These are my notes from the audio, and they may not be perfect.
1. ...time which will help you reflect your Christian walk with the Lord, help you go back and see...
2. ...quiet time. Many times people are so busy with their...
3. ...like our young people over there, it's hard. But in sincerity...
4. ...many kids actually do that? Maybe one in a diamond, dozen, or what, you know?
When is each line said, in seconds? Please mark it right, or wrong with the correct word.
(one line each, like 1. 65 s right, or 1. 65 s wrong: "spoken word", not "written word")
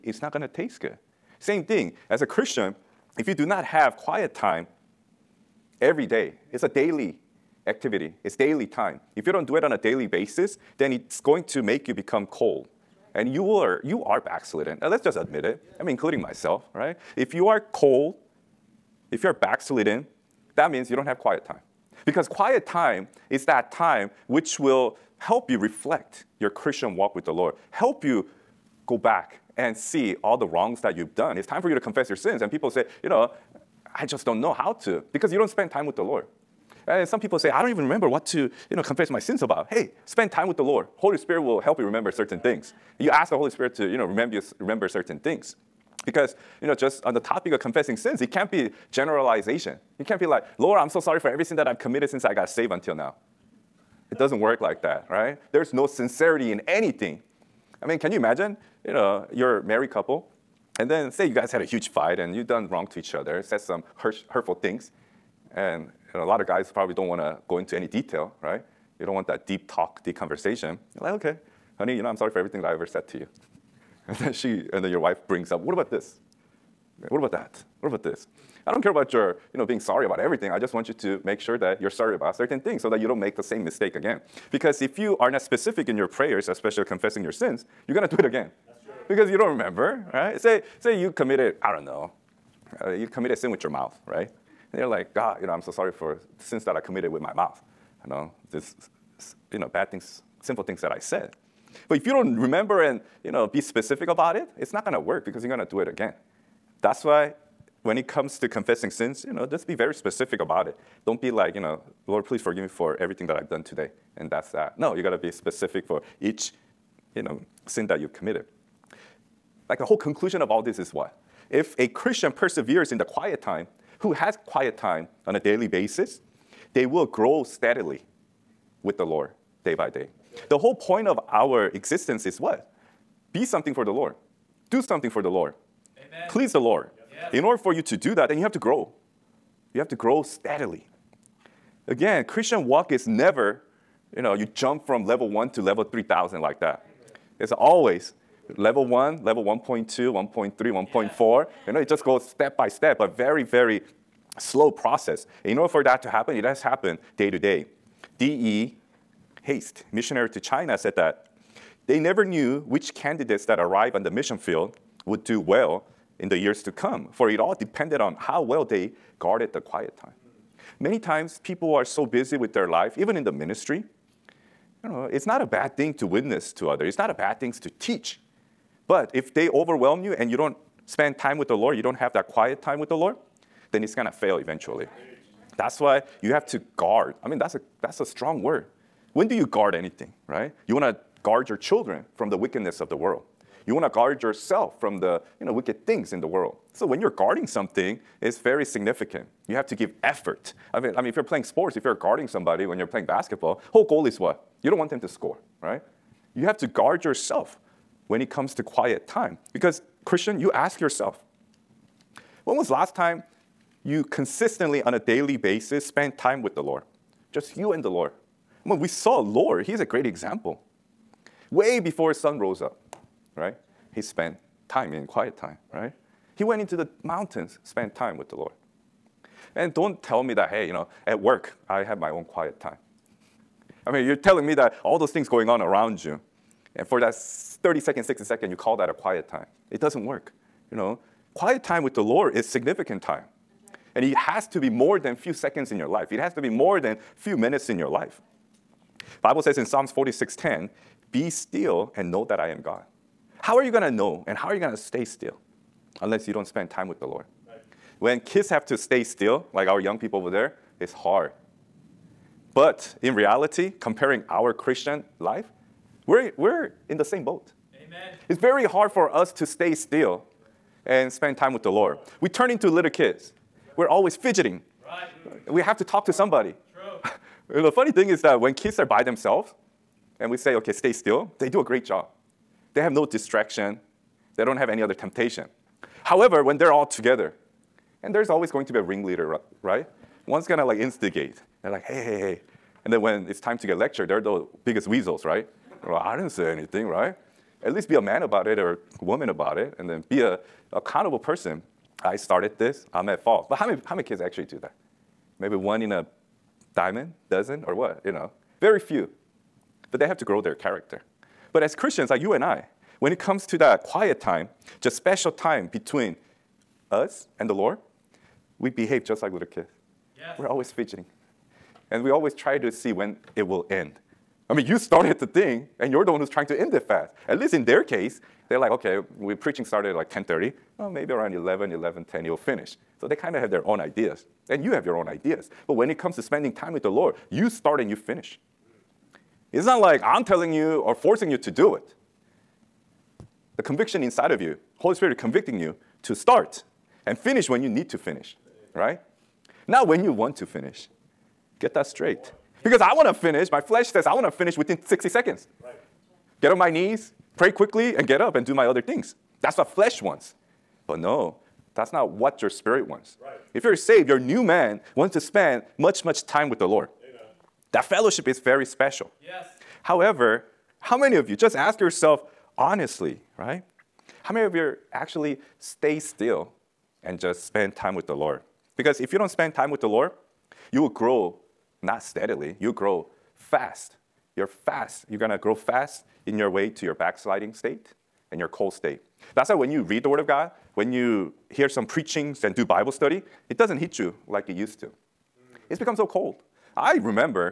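1. 23 s right
2. 169 s right
3. 259 s wrong: "reality", not "sincerity"
4. 303 s right.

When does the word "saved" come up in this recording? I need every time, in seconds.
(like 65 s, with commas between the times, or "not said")
52 s, 363 s.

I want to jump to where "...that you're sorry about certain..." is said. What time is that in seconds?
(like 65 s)
81 s.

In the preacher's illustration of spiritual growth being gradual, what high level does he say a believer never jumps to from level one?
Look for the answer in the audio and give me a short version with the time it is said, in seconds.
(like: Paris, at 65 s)
level 3,000, at 145 s.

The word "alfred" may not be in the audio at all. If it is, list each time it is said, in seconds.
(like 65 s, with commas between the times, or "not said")
not said.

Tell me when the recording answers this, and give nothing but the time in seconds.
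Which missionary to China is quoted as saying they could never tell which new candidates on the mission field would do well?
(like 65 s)
158 s.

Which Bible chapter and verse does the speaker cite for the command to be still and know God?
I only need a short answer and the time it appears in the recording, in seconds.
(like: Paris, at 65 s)
Psalms 46:10, at 249 s.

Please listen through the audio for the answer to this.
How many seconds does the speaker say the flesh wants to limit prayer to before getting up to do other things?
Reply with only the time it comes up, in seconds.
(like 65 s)
354 s.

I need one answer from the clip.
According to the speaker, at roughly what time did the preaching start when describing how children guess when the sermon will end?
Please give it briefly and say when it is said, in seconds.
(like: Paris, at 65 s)
10:30, at 330 s.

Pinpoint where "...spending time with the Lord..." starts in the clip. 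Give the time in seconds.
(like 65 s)
336 s.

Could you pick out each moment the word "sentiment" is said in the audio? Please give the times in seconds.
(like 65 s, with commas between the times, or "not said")
not said.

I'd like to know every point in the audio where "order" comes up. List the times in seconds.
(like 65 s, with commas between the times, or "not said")
137 s, 155 s.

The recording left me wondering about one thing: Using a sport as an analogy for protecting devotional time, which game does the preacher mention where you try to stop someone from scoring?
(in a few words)
basketball.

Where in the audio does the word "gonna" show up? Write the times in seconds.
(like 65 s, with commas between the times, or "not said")
87 s, 183 s, 290 s.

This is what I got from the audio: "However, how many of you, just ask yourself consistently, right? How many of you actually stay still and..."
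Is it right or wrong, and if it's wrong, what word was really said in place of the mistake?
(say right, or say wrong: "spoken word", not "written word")
wrong: "honestly", not "consistently".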